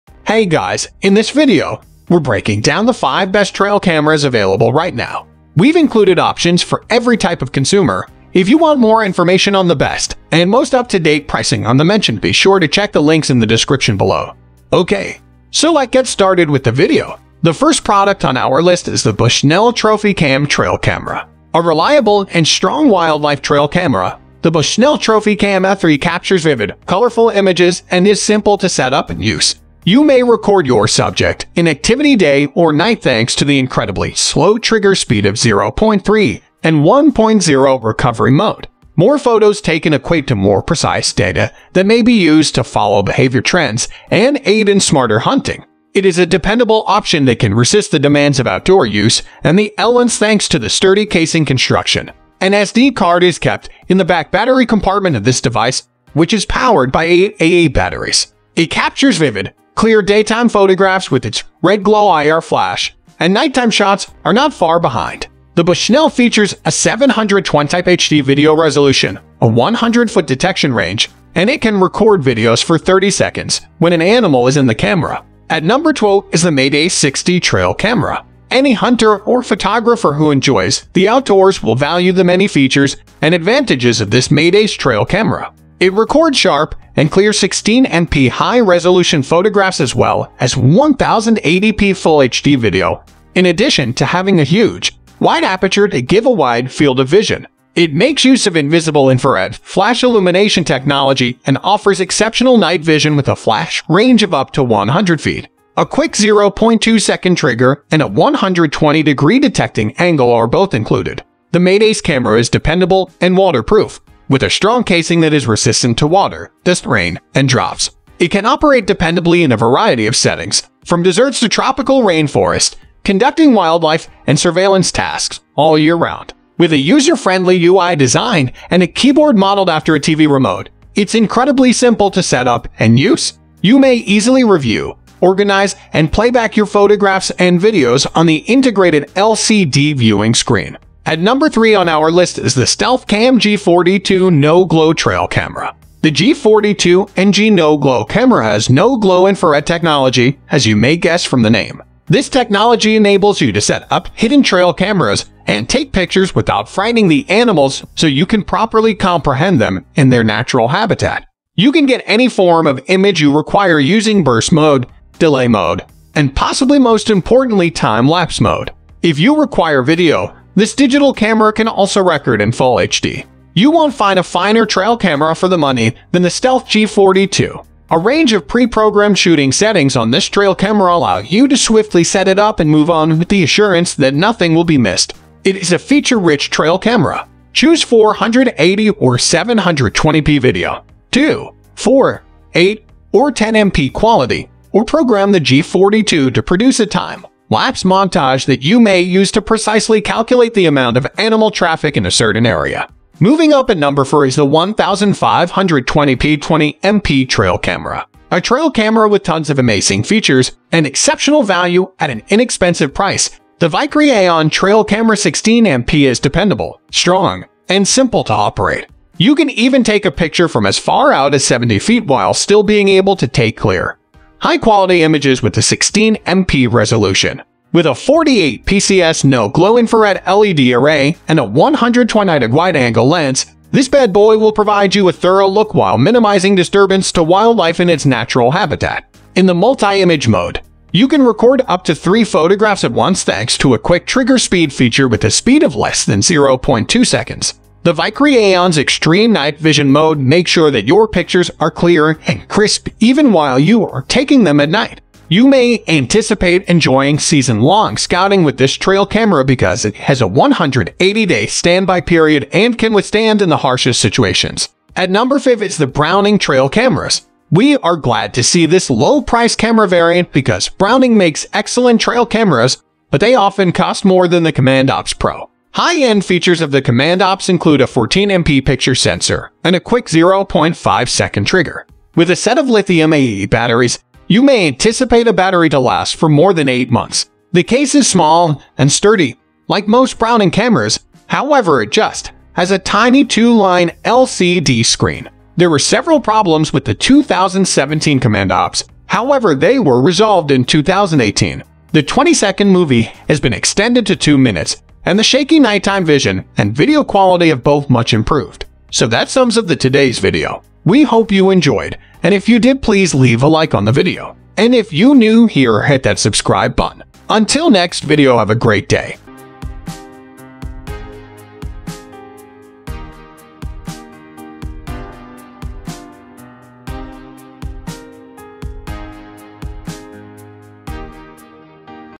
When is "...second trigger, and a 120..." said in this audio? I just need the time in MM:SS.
01:47.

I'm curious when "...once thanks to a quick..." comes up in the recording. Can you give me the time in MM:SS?
04:02.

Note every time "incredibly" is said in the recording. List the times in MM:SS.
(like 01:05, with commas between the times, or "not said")
00:33, 02:11.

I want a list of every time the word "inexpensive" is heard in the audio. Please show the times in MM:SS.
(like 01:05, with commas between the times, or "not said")
03:32.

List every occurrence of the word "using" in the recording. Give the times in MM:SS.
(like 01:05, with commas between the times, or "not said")
02:43.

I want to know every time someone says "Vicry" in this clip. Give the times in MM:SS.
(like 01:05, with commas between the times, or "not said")
03:33, 04:07.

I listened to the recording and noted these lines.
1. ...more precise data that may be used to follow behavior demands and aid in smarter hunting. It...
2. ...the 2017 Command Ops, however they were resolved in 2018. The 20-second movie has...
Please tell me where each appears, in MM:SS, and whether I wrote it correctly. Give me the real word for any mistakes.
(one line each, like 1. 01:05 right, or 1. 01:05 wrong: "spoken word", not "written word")
1. 00:40 wrong: "trends", not "demands"
2. 04:56 right.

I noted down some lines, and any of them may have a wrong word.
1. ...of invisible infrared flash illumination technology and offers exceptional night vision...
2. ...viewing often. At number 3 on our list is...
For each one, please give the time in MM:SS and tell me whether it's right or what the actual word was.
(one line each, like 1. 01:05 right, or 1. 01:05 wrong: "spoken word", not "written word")
1. 01:38 right
2. 02:19 wrong: "screen", not "often".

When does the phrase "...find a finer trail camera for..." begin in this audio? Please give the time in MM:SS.
02:53.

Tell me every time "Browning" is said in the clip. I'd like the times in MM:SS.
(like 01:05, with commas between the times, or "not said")
04:25, 04:30, 04:50.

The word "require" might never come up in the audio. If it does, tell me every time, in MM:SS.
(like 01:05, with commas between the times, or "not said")
02:43, 02:49.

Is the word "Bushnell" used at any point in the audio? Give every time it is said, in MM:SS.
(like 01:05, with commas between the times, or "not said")
00:19, 00:24, 01:05.